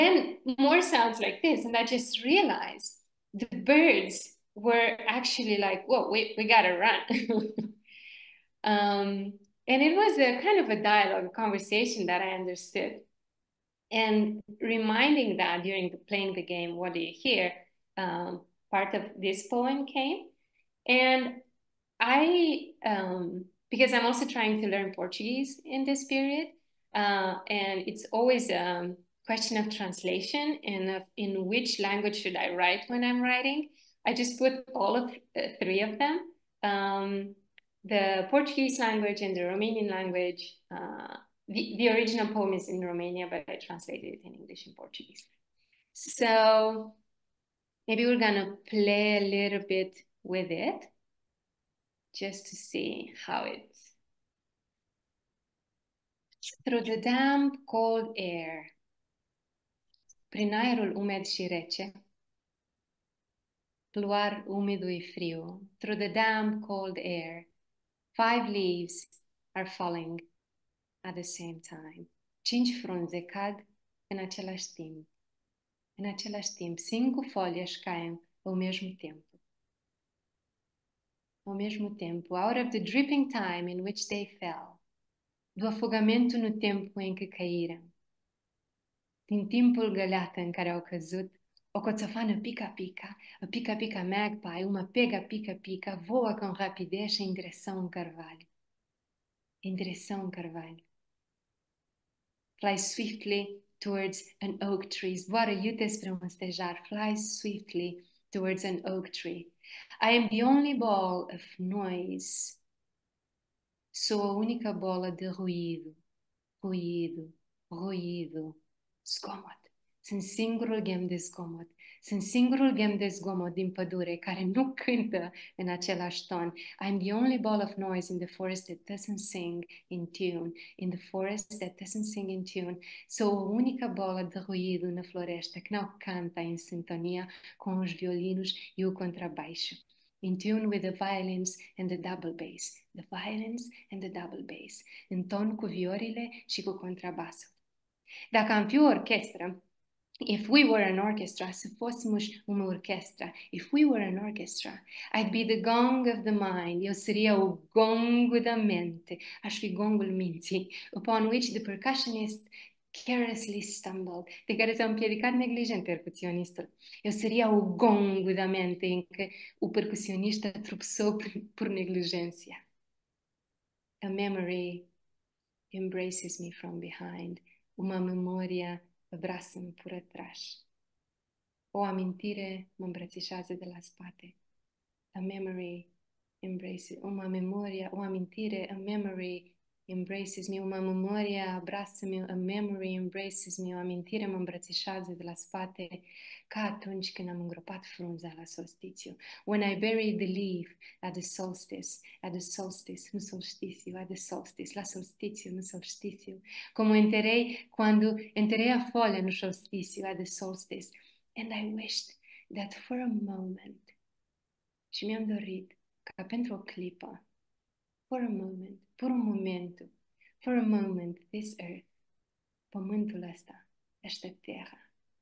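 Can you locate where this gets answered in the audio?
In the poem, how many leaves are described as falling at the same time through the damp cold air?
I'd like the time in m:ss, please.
1:08.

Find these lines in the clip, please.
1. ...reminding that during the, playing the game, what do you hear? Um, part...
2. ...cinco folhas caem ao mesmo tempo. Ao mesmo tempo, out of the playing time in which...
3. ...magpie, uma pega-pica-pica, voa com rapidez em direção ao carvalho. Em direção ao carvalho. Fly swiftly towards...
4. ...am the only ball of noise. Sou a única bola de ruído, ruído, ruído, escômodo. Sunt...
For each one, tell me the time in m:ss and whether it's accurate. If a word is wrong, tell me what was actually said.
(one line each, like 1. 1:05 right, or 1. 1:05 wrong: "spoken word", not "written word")
1. 0:14 right
2. 1:16 wrong: "dripping", not "playing"
3. 1:34 right
4. 1:50 right.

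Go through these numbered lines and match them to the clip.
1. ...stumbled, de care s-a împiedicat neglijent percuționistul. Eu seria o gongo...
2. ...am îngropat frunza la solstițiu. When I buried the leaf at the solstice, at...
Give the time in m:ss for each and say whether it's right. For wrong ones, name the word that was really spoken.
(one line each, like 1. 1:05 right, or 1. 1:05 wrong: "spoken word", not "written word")
1. 2:43 right
2. 3:17 right.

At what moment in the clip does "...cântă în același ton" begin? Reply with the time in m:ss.
2:04.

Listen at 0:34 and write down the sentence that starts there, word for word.
I just put all of uh, three of them.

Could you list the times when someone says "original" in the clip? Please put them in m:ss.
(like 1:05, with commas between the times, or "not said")
0:41.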